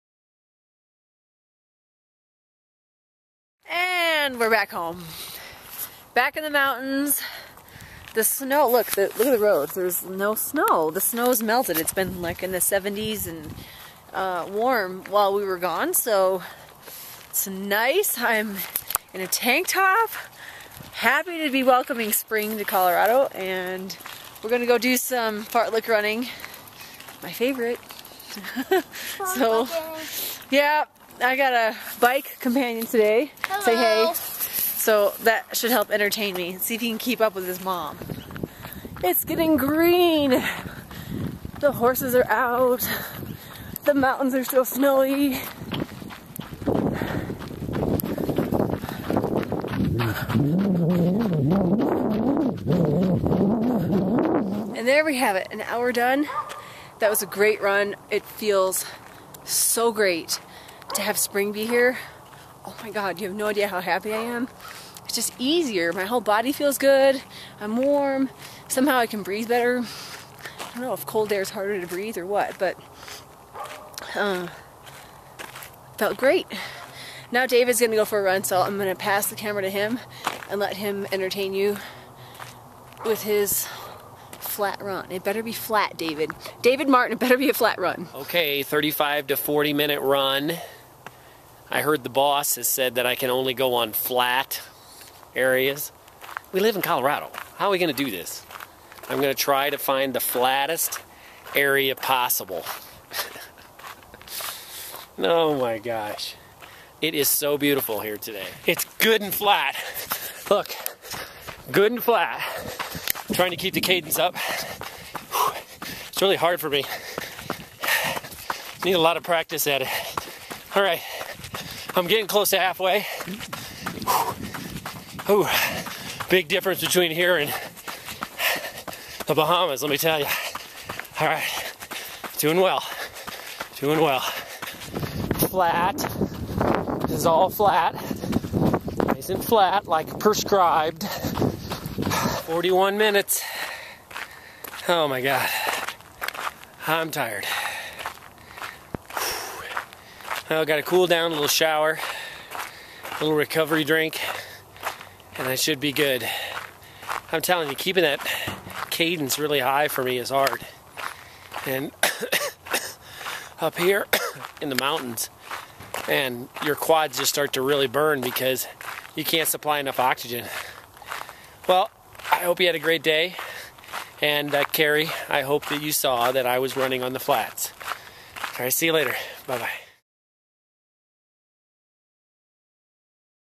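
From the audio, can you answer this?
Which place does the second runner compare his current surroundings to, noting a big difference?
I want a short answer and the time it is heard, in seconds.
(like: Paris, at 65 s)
the Bahamas, at 129 s.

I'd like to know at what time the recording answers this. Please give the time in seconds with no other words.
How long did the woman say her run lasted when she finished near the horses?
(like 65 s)
55 s.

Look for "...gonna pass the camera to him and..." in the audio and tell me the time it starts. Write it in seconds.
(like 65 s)
78 s.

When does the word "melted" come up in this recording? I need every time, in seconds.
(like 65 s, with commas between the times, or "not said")
11 s.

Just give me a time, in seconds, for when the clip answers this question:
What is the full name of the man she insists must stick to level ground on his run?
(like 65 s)
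86 s.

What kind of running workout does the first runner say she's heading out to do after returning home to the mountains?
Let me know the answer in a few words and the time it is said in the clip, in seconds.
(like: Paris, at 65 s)
fartlek, at 25 s.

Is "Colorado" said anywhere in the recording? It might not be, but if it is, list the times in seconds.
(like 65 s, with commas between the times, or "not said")
22 s, 96 s.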